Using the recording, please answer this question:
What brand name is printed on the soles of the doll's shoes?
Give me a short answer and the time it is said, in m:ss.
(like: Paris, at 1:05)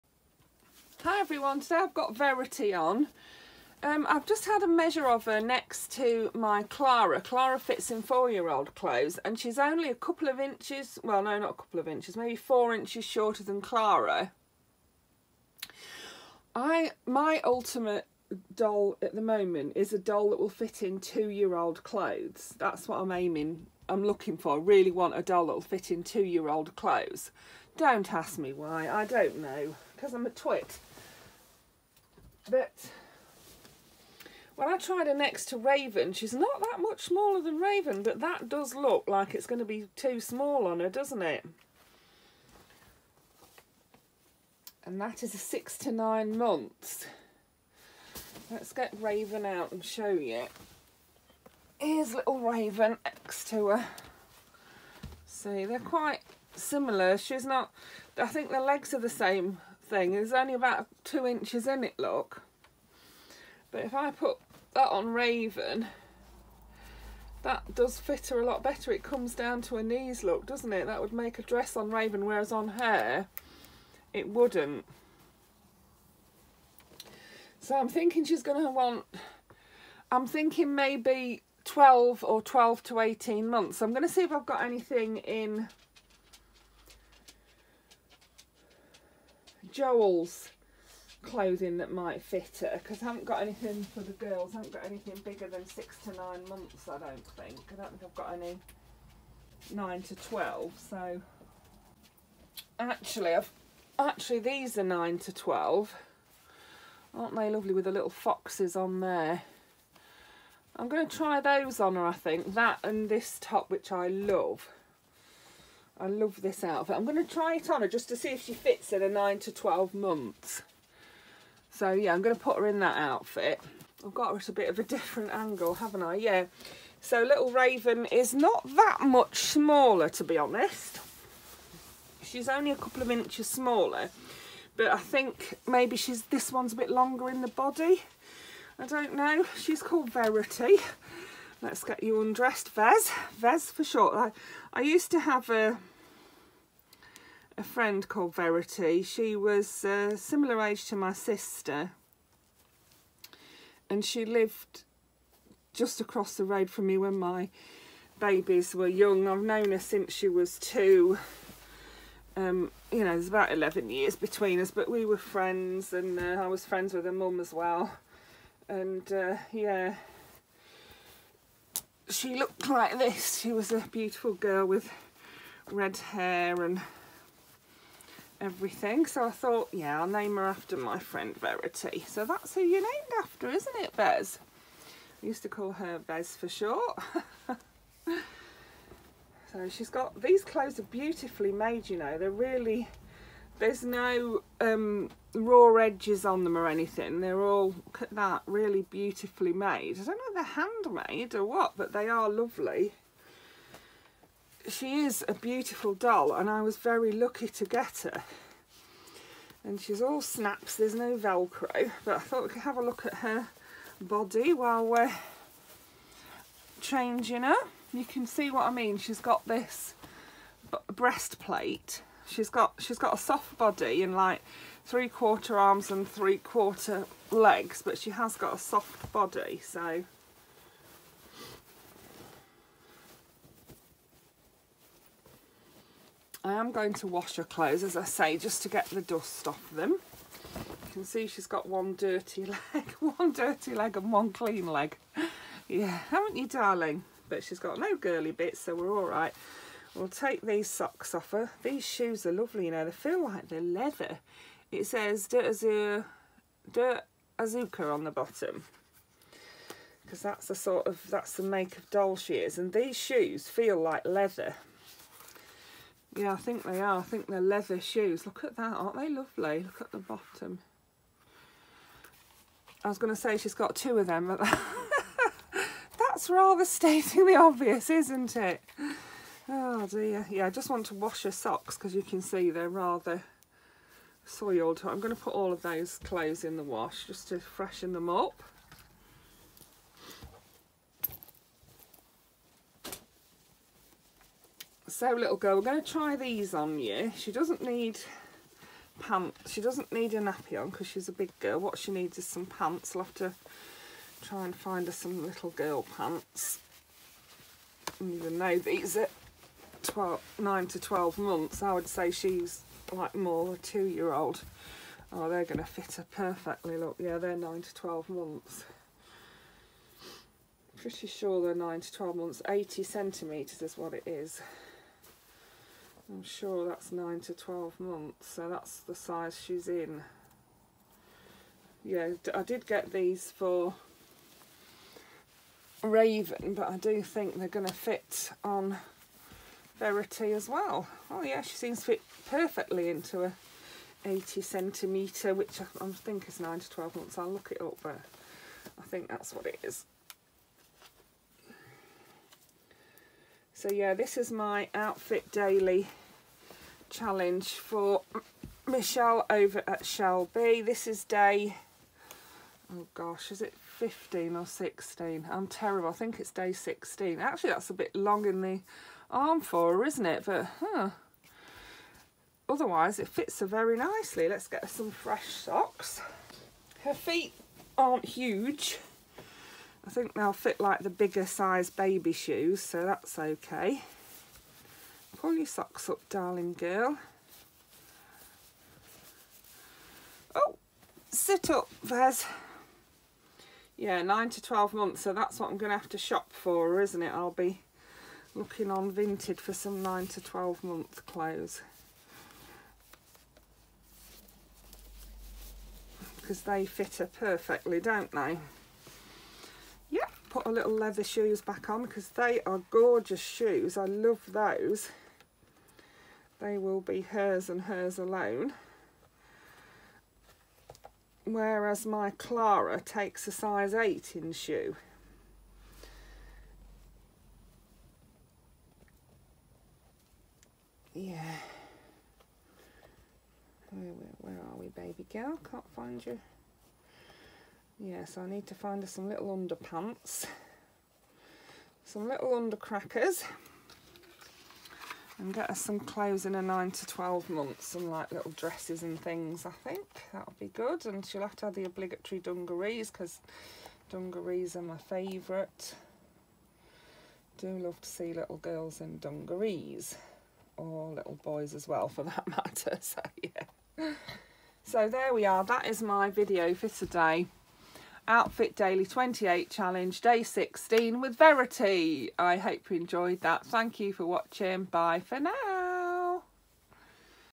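Dirt Azuka, at 4:16.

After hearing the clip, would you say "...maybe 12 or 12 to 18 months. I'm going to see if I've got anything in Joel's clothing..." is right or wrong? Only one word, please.
right.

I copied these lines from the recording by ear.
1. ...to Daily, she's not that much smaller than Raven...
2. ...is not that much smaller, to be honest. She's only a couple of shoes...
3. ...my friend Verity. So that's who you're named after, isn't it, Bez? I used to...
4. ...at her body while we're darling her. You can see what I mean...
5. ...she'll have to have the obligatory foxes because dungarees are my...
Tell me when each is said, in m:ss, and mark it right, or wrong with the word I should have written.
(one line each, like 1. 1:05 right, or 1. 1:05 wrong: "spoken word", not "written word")
1. 0:35 wrong: "Raven", not "Daily"
2. 2:08 wrong: "inches", not "shoes"
3. 3:00 right
4. 3:33 wrong: "changing", not "darling"
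5. 7:31 wrong: "dungarees", not "foxes".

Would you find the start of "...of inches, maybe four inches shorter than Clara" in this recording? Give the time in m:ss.
0:11.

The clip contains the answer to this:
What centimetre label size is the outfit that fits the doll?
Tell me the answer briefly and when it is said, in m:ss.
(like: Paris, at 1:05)
80, at 5:22.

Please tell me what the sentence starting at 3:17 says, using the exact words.
They're all, look at that, really beautifully made.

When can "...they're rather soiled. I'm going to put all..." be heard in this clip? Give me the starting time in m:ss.
4:42.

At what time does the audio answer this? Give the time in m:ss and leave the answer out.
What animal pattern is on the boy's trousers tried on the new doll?
1:47.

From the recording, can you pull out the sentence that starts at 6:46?
Because they fit her perfectly, don't they?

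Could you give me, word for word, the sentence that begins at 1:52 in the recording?
That and this top, which I love.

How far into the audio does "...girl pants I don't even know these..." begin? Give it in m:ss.
5:05.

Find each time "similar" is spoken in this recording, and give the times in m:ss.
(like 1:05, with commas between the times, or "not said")
0:56, 2:30.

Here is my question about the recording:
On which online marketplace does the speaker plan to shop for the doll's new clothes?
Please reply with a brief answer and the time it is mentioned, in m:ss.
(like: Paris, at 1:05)
Vinted, at 6:38.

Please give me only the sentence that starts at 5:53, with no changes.
So yeah, this is my outfit daily challenge for Michelle over at ShellBea.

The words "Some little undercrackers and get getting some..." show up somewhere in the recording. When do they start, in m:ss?
7:21.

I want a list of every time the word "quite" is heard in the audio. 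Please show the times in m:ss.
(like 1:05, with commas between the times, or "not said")
0:55.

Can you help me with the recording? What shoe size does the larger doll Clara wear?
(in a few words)
8.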